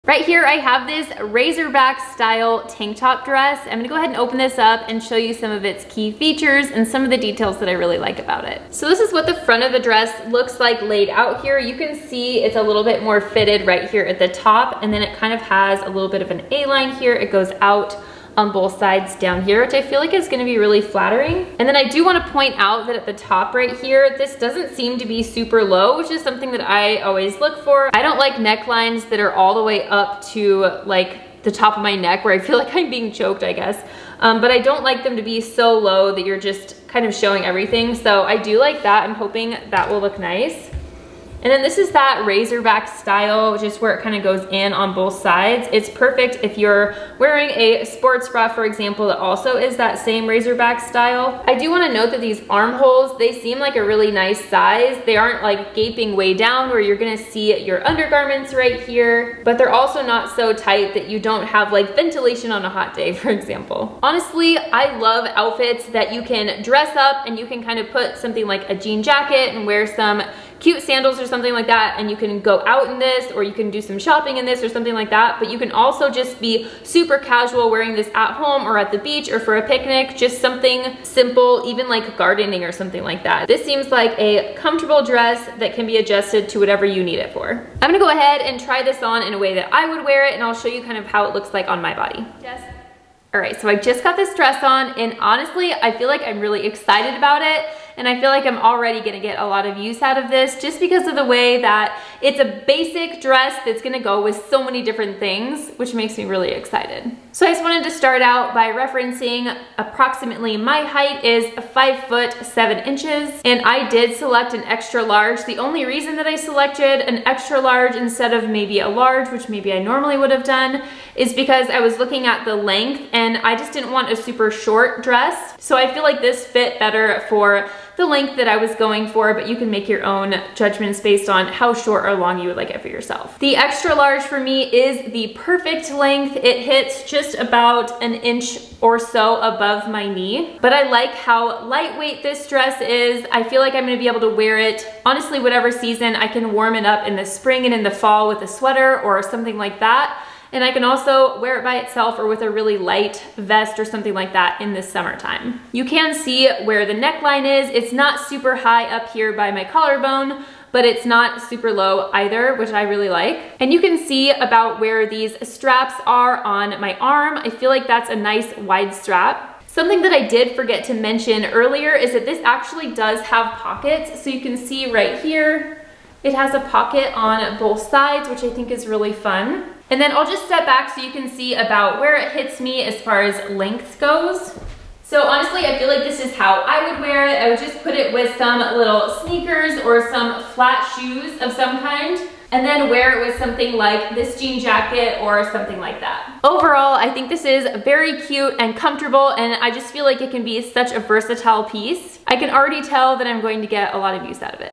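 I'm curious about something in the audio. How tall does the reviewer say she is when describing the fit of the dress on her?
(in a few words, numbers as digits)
5 feet 7 inches.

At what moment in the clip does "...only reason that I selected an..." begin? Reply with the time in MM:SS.
01:55.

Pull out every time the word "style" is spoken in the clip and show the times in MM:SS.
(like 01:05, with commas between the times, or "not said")
00:02, 00:42, 00:50.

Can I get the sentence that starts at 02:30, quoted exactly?
And I can also wear it by itself or with a really light vest or something like that in the summertime.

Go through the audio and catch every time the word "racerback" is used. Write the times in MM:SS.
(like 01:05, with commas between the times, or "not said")
00:01, 00:42, 00:50.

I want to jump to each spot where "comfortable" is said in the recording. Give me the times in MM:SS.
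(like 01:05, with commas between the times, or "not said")
01:24, 03:18.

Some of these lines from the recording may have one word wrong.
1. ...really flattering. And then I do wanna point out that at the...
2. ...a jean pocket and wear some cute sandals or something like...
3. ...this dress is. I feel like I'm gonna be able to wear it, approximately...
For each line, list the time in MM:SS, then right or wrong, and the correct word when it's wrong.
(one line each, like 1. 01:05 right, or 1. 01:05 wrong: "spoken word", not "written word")
1. 00:20 right
2. 01:08 wrong: "jacket", not "pocket"
3. 02:22 wrong: "honestly", not "approximately".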